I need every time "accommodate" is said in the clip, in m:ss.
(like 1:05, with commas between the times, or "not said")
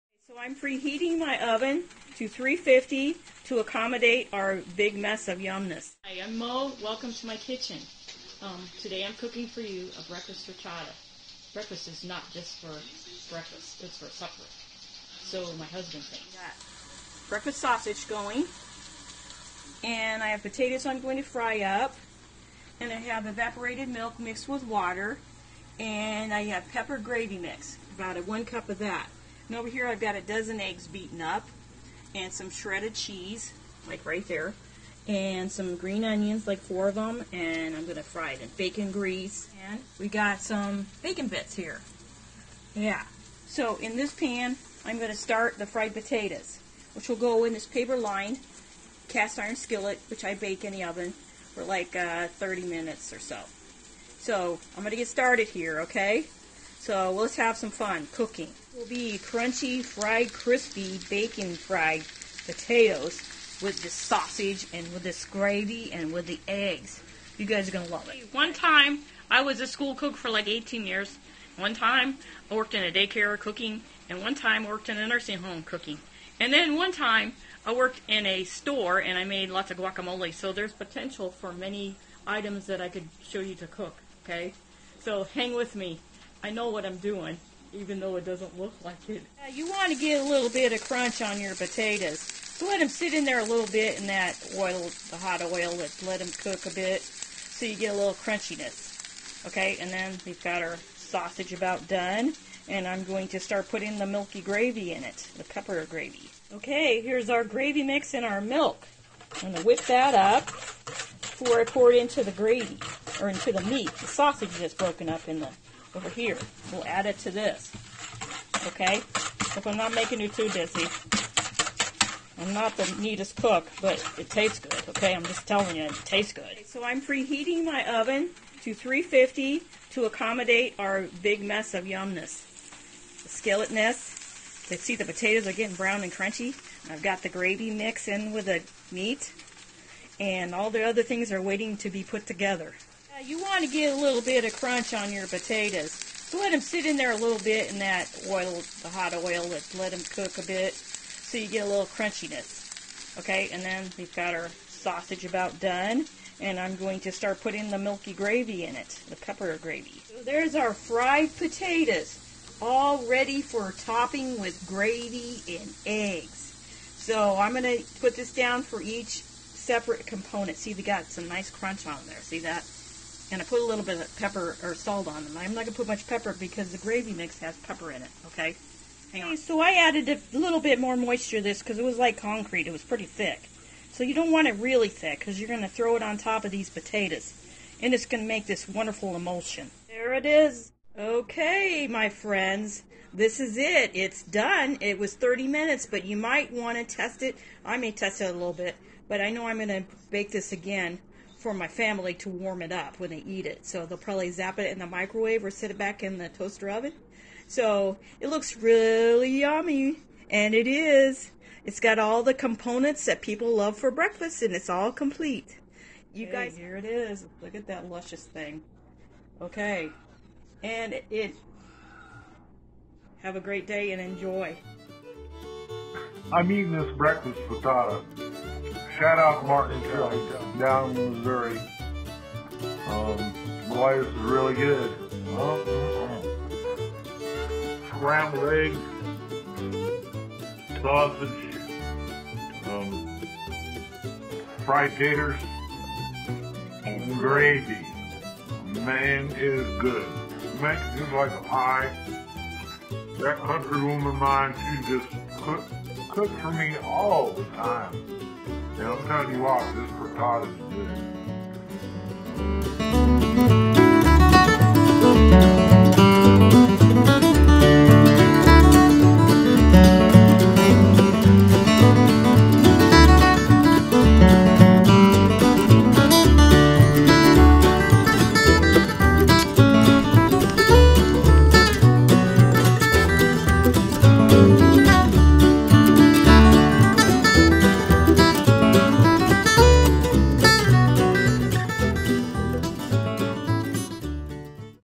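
0:03, 2:10.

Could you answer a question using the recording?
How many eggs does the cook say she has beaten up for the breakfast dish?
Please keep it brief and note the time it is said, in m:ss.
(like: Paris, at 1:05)
12, at 0:30.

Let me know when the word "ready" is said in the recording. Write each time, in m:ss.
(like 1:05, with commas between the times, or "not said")
2:43.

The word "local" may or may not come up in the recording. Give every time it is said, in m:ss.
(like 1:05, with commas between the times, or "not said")
not said.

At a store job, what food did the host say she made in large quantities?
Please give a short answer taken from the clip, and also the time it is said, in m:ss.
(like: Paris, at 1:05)
guacamole, at 1:19.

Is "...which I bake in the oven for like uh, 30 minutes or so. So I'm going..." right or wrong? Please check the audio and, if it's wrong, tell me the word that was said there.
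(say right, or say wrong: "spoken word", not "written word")
right.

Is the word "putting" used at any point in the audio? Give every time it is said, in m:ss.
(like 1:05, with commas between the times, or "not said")
1:43, 2:37.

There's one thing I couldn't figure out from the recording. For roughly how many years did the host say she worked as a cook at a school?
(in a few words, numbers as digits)
18.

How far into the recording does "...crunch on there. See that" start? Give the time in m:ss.
2:51.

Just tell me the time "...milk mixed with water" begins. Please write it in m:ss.
0:23.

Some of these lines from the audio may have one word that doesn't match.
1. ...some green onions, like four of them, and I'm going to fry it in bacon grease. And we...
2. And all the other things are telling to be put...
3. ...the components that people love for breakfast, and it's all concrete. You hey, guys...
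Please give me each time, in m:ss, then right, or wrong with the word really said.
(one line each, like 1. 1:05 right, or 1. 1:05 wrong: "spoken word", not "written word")
1. 0:35 right
2. 2:20 wrong: "waiting", not "telling"
3. 3:32 wrong: "complete", not "concrete".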